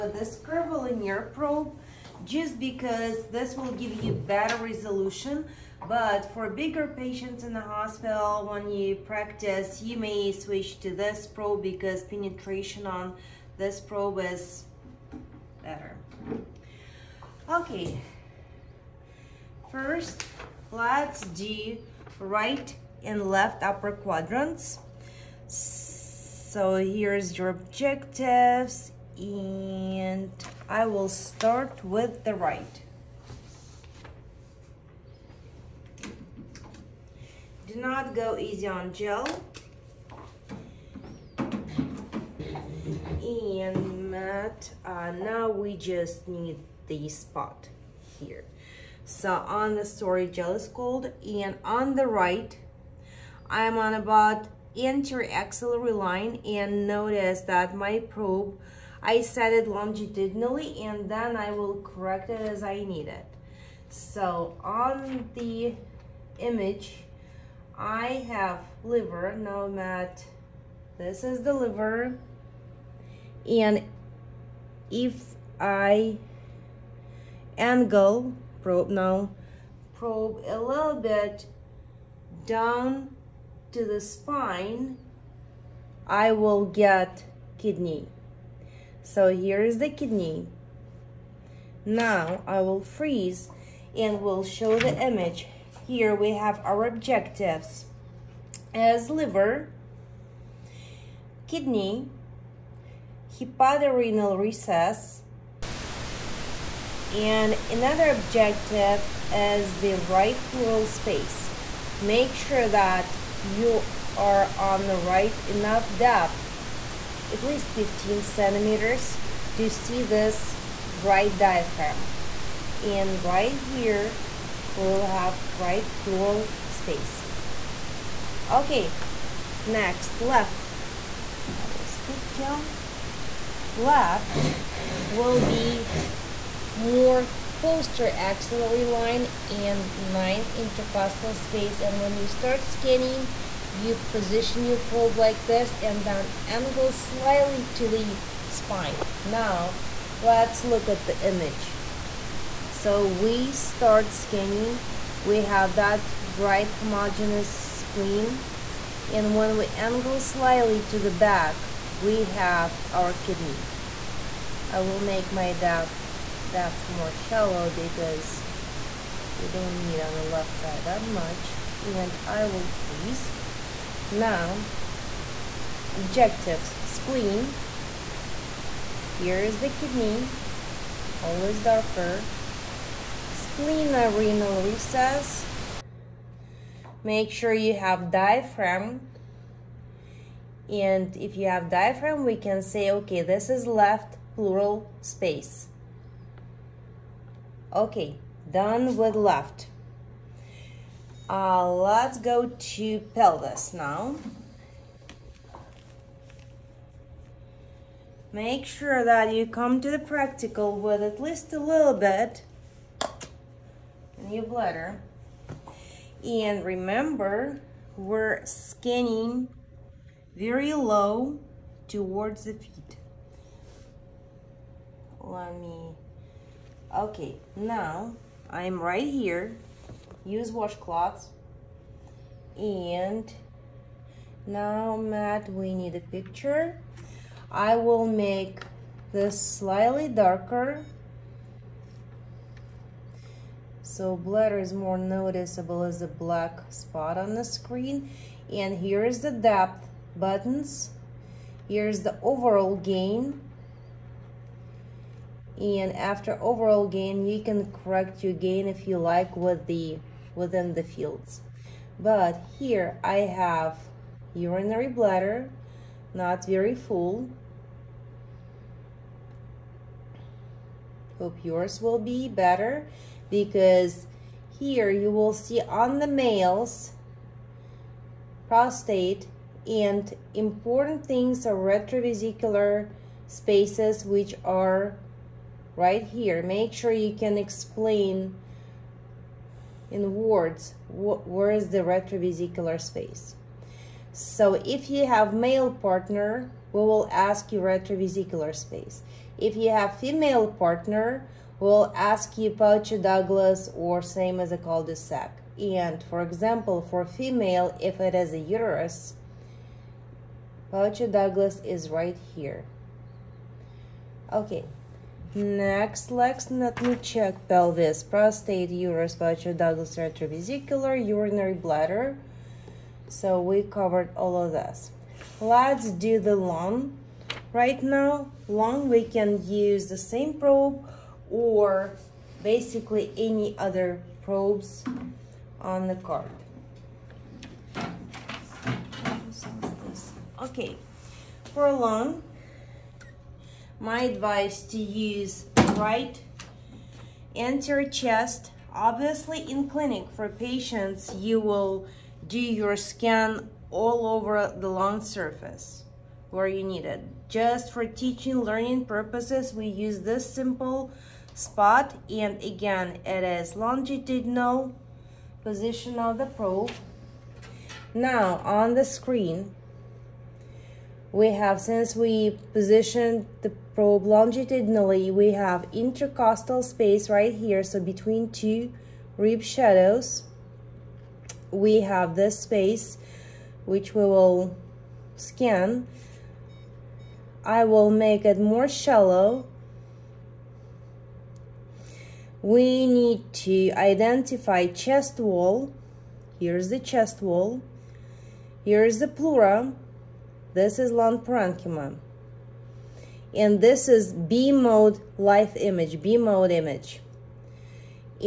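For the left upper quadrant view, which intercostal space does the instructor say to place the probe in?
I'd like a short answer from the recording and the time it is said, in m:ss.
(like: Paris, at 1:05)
ninth, at 2:20.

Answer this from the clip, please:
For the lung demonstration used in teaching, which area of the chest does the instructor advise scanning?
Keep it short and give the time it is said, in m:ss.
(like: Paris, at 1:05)
right anterior chest, at 5:45.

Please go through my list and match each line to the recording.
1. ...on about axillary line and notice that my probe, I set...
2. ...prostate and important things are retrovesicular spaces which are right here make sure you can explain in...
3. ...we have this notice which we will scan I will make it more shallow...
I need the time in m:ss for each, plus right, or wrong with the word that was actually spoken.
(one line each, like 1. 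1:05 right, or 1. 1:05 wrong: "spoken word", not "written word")
1. 0:53 right
2. 4:38 right
3. 6:21 wrong: "space", not "notice".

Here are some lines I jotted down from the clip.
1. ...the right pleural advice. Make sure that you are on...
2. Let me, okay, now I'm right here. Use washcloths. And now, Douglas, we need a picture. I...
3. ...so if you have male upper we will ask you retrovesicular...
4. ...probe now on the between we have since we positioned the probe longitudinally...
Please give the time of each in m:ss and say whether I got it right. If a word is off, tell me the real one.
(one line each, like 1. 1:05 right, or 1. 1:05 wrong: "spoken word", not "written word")
1. 1:49 wrong: "space", not "advice"
2. 3:45 wrong: "Matt", not "Douglas"
3. 4:54 wrong: "partner", not "upper"
4. 6:06 wrong: "screen", not "between".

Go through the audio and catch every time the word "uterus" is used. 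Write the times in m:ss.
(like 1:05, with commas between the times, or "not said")
5:08, 5:18.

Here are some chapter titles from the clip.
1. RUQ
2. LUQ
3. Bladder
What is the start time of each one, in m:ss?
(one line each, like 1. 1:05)
1. 0:34
2. 2:13
3. 3:20.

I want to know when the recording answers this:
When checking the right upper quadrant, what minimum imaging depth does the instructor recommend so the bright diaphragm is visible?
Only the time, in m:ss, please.
1:57.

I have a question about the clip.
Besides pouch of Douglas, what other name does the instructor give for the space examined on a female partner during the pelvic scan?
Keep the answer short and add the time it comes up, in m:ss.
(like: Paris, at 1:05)
cul-de-sac, at 5:04.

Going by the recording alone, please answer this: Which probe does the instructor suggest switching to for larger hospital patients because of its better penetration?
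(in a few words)
curvilinear probe.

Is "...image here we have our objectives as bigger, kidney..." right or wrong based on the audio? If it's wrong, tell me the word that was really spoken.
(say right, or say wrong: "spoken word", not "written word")
wrong: "liver", not "bigger".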